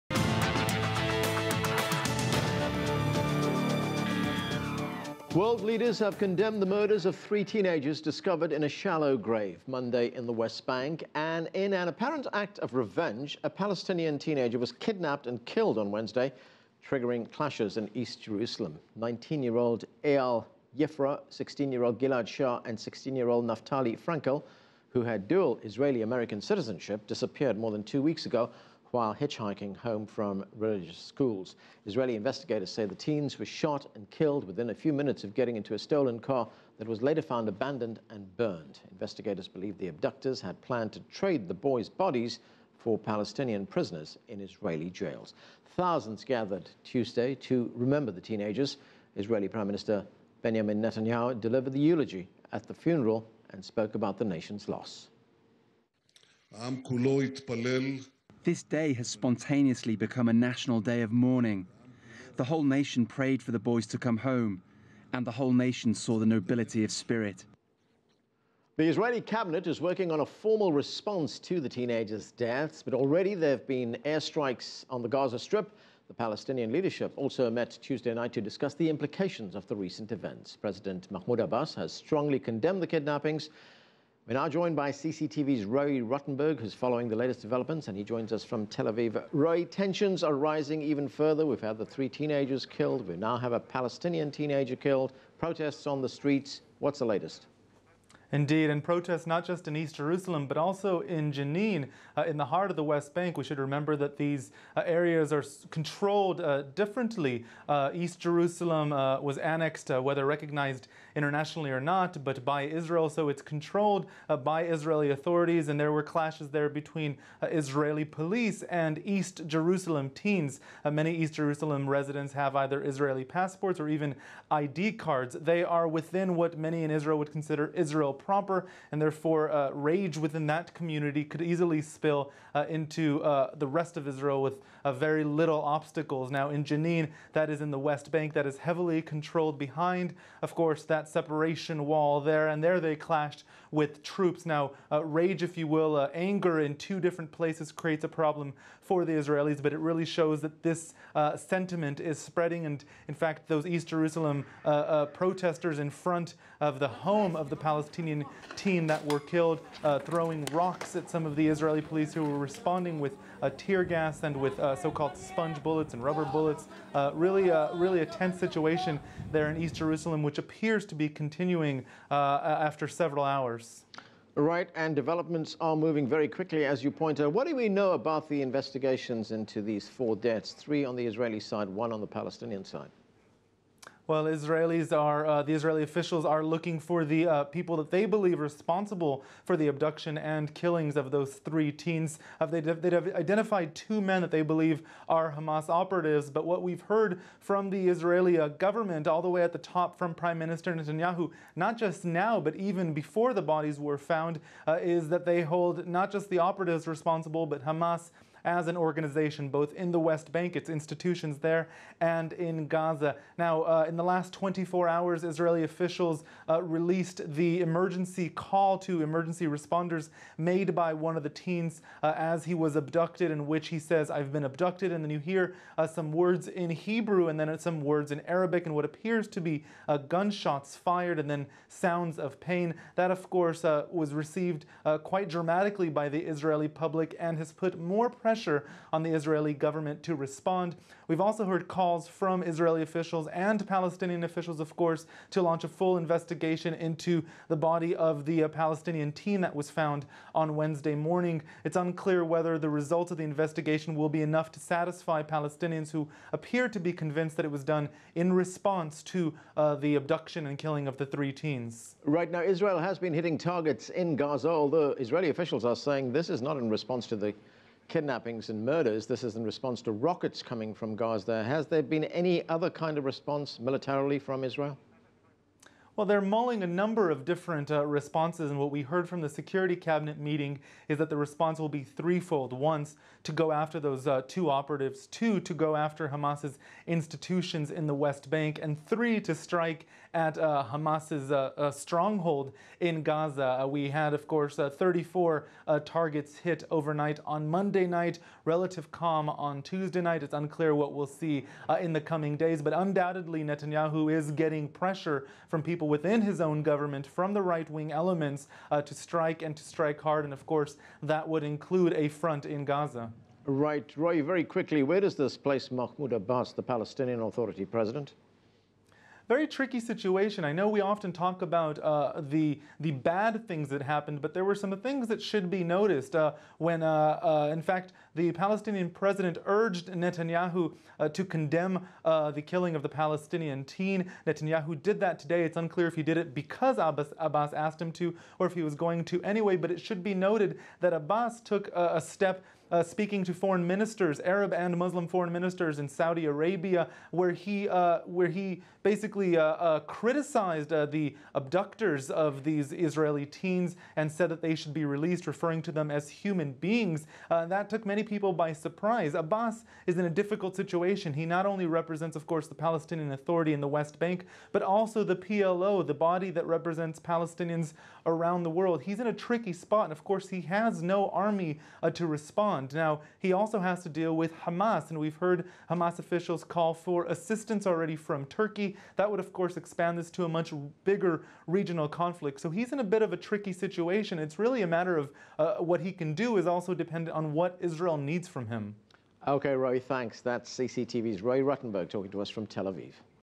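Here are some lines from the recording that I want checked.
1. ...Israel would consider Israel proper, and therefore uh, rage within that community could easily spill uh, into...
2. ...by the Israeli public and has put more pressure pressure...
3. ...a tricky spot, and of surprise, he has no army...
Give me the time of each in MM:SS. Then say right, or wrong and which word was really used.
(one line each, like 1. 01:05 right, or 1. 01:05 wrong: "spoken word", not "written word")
1. 02:06 right
2. 03:55 right
3. 06:09 wrong: "course", not "surprise".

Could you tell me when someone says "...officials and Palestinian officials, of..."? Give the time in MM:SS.
04:02.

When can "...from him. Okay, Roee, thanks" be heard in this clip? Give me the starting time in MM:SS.
06:28.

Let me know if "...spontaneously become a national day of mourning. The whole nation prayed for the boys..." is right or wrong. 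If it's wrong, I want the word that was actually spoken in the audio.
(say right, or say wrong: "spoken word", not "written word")
right.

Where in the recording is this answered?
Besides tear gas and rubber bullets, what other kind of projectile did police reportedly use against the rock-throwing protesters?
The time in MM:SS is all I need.
02:45.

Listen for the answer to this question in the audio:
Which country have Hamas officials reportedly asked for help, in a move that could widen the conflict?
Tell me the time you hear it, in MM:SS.
06:18.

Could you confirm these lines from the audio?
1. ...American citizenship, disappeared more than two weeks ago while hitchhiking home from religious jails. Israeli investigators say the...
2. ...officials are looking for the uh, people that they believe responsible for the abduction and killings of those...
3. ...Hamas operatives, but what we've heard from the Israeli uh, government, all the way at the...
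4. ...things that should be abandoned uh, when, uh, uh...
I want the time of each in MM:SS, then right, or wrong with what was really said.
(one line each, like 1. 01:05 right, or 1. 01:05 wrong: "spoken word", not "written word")
1. 00:26 wrong: "schools", not "jails"
2. 03:05 right
3. 03:15 right
4. 05:24 wrong: "noticed", not "abandoned".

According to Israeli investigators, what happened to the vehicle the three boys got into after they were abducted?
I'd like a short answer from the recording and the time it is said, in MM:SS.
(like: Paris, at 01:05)
abandoned and burned, at 00:37.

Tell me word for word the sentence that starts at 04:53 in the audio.
Uh, we had, of course, 34 targets hit overnight on Monday night, relative calm on Tuesday night.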